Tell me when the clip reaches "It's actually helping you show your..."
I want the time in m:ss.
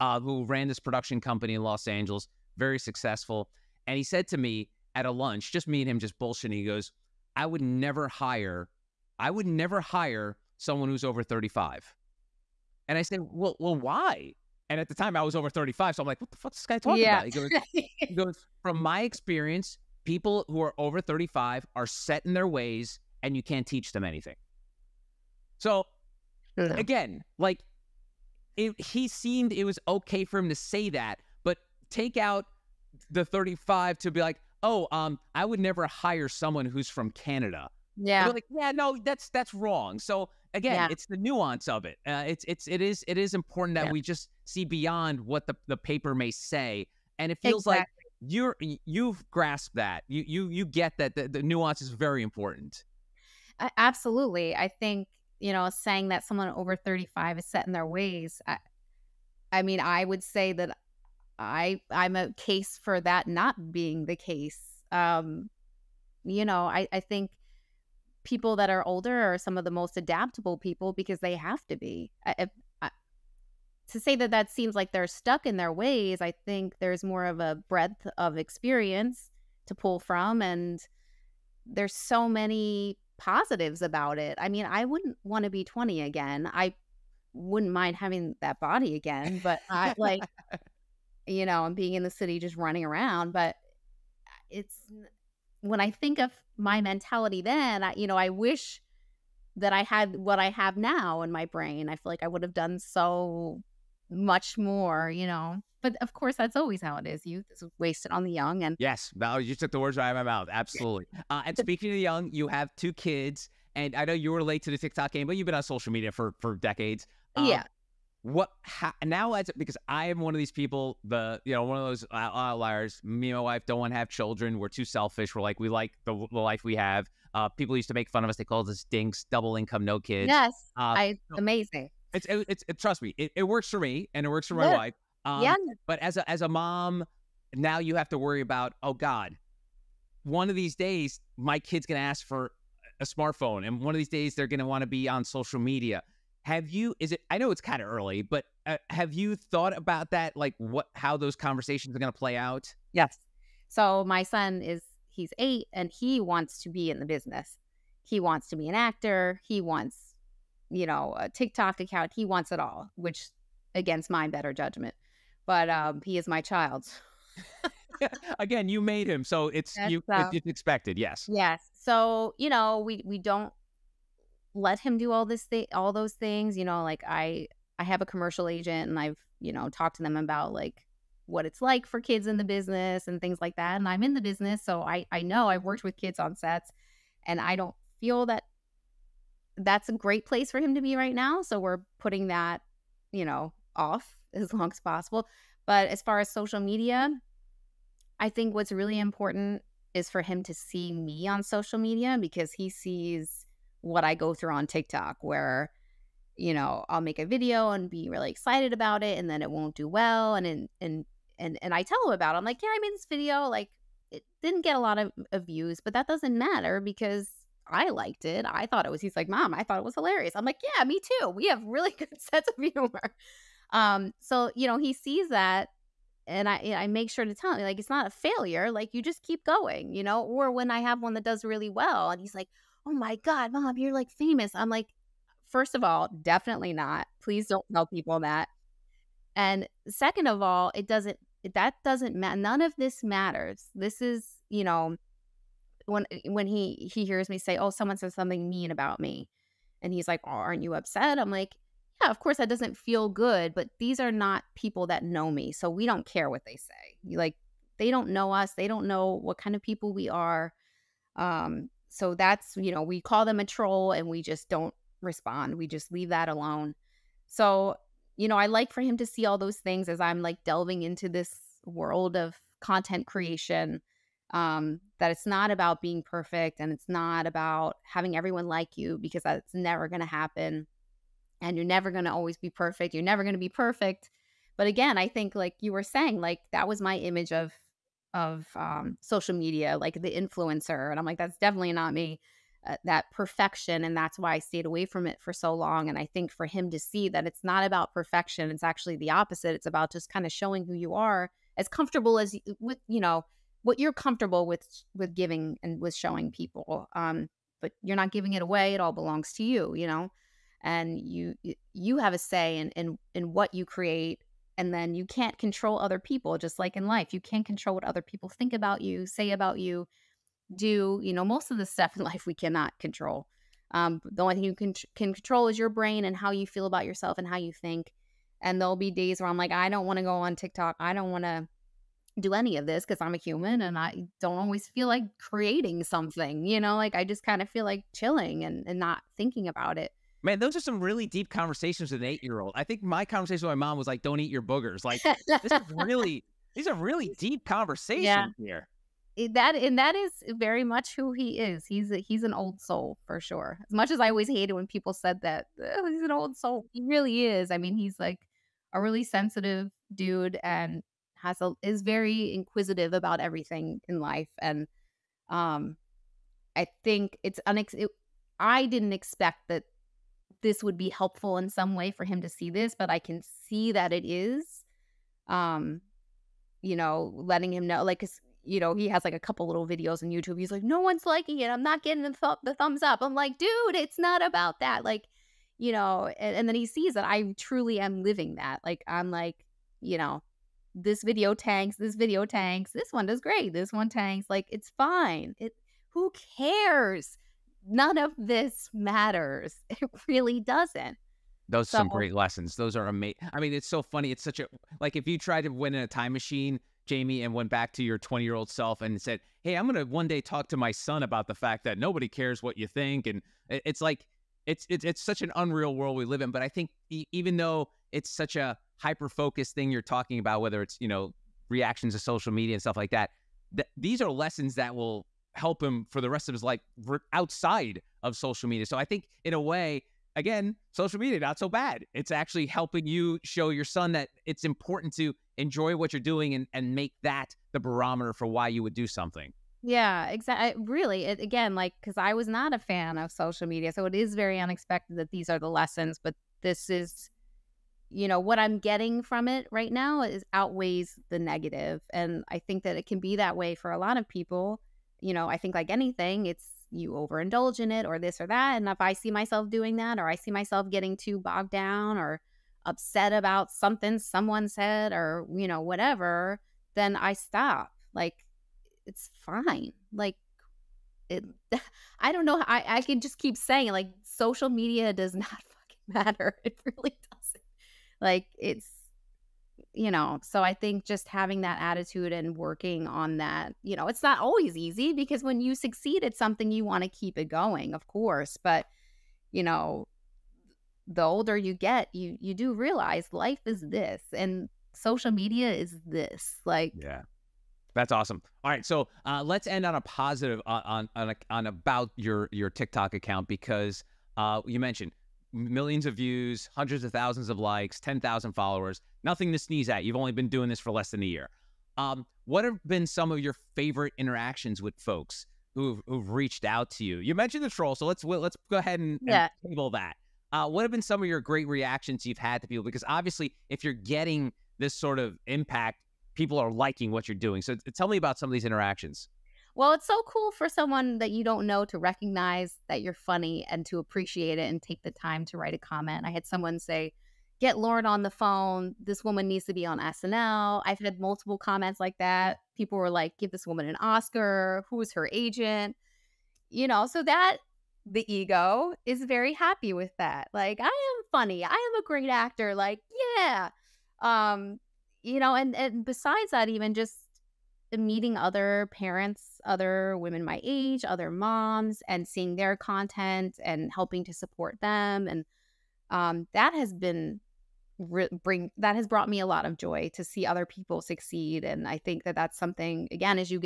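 7:11.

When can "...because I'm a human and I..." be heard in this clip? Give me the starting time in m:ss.
5:32.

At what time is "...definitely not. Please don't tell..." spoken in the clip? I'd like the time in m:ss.
3:56.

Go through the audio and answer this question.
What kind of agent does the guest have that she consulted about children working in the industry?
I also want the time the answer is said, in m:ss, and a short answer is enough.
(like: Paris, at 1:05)
Commercial agent, at 2:58.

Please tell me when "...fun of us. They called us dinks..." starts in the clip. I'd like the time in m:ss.
2:08.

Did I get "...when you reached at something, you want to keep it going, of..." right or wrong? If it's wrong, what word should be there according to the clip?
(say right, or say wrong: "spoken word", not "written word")
wrong: "succeed", not "reached".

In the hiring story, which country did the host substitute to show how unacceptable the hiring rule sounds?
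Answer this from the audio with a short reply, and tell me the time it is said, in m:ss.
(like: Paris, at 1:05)
Canada, at 0:37.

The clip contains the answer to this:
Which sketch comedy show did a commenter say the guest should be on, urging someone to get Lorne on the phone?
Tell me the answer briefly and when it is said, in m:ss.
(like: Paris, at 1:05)
SNL, at 8:59.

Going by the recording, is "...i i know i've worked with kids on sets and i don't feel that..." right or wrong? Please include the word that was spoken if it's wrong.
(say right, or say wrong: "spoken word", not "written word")
right.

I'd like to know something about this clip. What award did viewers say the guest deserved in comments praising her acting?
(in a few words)
Oscar.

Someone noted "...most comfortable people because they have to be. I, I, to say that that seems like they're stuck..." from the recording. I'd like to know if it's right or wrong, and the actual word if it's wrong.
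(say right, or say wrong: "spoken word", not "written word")
wrong: "adaptable", not "comfortable".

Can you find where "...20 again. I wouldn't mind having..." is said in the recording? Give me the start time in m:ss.
1:25.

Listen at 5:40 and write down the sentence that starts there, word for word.
Man, those are some really deep conversations with an eight year old.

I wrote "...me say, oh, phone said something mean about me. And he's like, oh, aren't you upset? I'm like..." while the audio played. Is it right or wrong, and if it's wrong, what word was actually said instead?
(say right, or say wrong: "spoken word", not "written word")
wrong: "someone", not "phone".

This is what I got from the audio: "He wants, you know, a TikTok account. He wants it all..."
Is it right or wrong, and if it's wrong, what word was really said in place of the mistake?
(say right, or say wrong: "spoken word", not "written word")
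right.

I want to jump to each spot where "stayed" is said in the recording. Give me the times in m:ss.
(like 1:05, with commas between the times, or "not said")
4:54.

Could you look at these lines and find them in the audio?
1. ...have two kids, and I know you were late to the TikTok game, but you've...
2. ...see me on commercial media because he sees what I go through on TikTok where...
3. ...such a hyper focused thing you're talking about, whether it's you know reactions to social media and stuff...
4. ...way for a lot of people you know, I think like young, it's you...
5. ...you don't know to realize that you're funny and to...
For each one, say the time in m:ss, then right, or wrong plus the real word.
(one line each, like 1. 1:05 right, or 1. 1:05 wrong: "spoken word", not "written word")
1. 1:52 right
2. 3:20 wrong: "social", not "commercial"
3. 6:58 right
4. 7:33 wrong: "anything", not "young"
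5. 8:51 wrong: "recognize", not "realize".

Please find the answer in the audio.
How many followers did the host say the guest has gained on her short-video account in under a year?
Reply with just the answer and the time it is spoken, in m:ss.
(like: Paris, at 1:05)
10,000, at 8:27.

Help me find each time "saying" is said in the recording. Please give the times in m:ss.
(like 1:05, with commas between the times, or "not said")
0:55, 4:45, 7:53.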